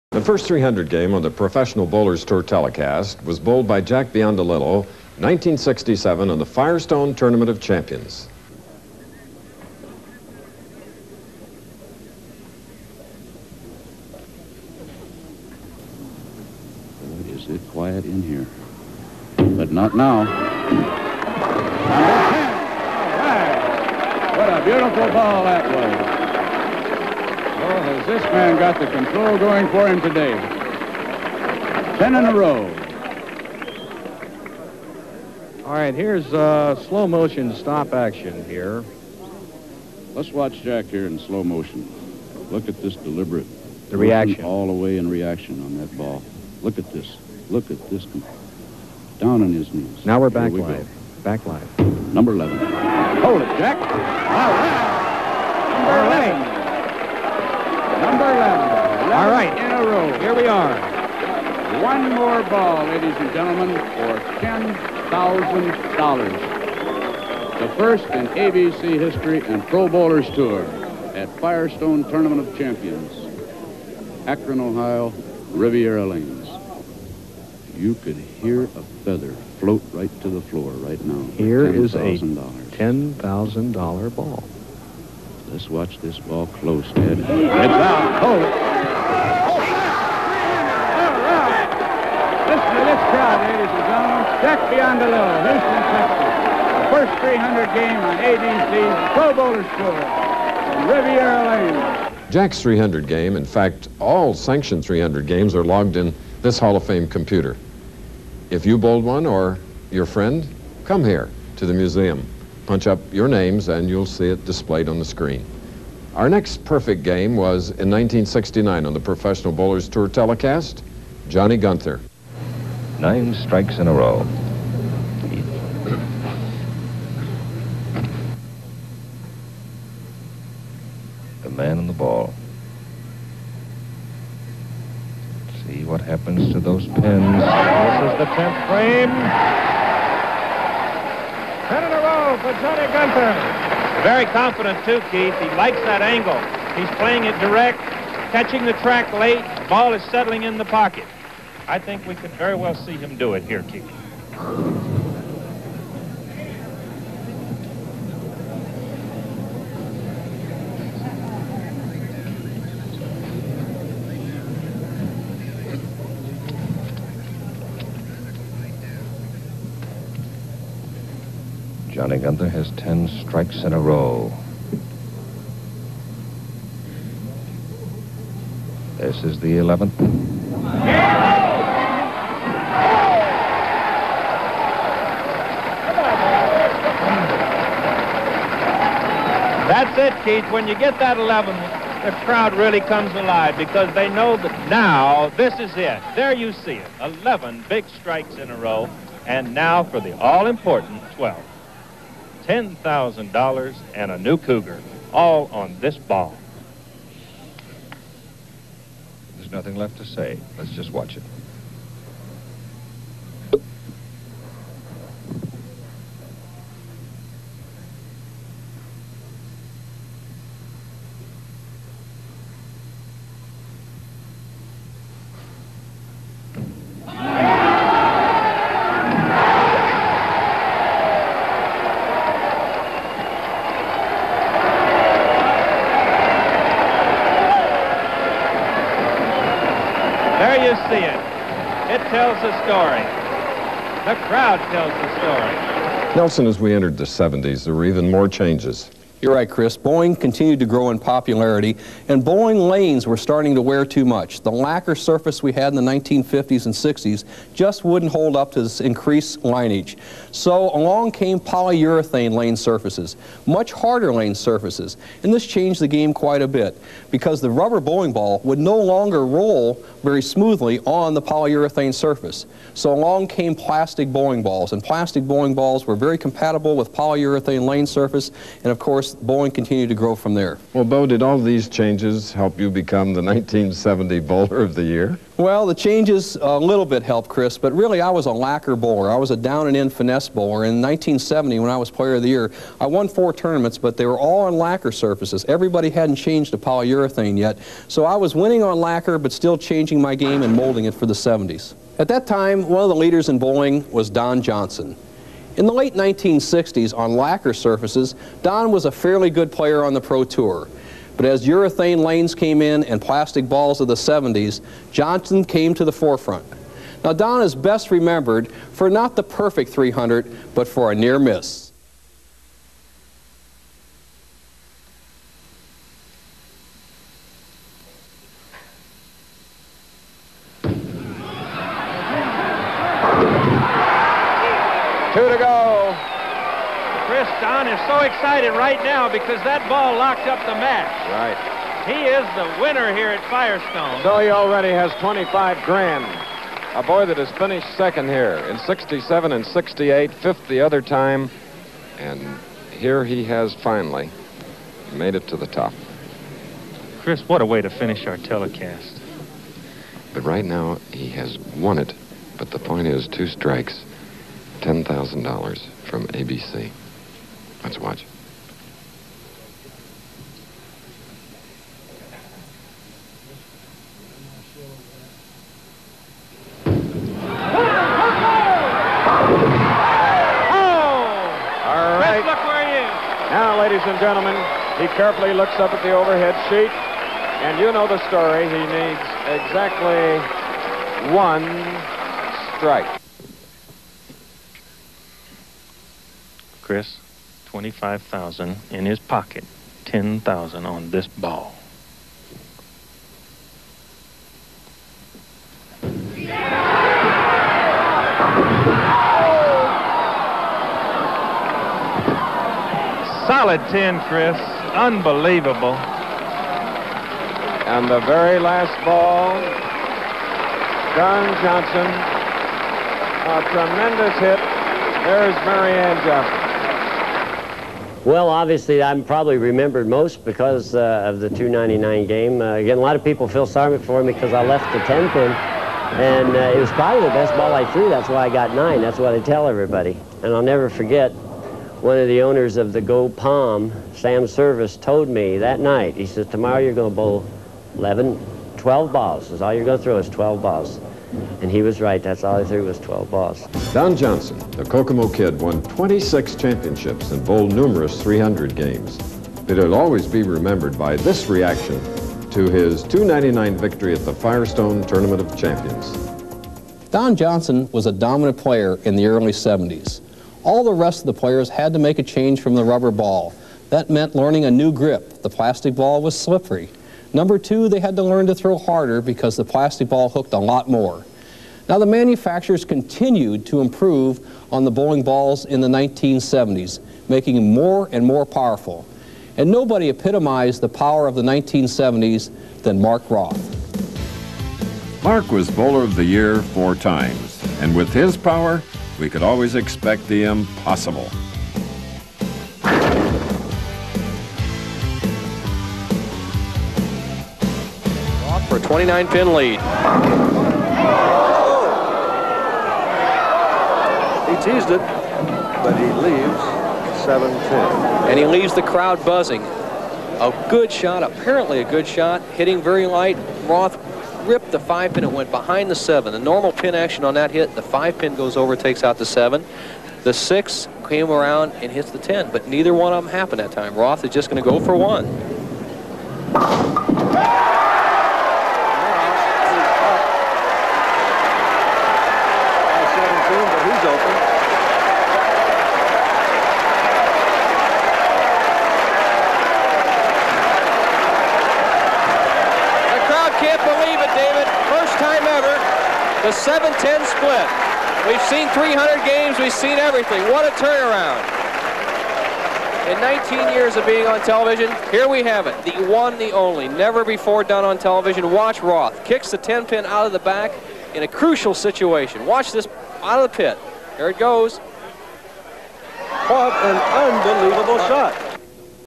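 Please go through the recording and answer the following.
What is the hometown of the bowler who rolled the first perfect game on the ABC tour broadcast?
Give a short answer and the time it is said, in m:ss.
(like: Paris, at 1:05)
Houston, Texas, at 1:35.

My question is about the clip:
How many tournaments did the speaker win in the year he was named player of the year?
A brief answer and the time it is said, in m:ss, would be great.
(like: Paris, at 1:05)
4, at 4:53.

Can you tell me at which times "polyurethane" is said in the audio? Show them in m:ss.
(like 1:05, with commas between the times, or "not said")
4:21, 4:31, 4:36, 4:56.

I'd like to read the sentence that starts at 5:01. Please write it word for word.
At that time, one of the leaders in bowling was Don Johnson.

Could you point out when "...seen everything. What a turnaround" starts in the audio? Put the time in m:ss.
9:19.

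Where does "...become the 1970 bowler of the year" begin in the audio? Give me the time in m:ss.
4:42.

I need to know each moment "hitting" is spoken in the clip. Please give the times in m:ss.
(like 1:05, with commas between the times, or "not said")
8:42.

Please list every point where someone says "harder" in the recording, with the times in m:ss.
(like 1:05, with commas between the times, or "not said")
4:23, 7:58.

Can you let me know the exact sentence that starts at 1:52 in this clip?
Punch up your names and you'll see it displayed on the screen.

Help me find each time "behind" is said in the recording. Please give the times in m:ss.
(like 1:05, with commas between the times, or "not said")
8:45.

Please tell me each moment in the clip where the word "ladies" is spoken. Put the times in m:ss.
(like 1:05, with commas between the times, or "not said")
1:02, 1:33, 6:23.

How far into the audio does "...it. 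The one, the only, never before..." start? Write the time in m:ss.
9:25.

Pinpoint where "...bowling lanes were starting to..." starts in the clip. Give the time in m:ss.
4:12.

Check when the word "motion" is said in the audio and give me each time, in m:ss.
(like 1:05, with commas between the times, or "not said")
0:37, 0:41.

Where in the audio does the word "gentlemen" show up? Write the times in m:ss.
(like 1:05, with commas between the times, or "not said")
1:03, 1:33, 6:24.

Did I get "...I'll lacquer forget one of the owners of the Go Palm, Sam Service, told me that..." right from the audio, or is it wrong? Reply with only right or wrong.
wrong.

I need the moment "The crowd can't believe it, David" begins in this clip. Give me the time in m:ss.
9:12.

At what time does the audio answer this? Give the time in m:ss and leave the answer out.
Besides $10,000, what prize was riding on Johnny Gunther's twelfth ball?
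3:24.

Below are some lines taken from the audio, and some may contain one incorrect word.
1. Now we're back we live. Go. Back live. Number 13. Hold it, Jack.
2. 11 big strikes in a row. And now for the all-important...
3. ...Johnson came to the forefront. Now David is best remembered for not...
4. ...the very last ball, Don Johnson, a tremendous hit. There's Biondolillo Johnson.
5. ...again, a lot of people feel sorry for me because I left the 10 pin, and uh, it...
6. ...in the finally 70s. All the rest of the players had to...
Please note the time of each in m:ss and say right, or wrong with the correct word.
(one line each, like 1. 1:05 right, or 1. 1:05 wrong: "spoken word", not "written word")
1. 0:50 wrong: "11", not "13"
2. 3:17 right
3. 5:14 wrong: "Don", not "David"
4. 6:57 wrong: "Marianne", not "Biondolillo"
5. 7:12 right
6. 7:48 wrong: "early", not "finally".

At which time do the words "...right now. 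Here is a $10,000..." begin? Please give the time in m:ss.
1:20.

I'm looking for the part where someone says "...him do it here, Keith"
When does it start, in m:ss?
2:32.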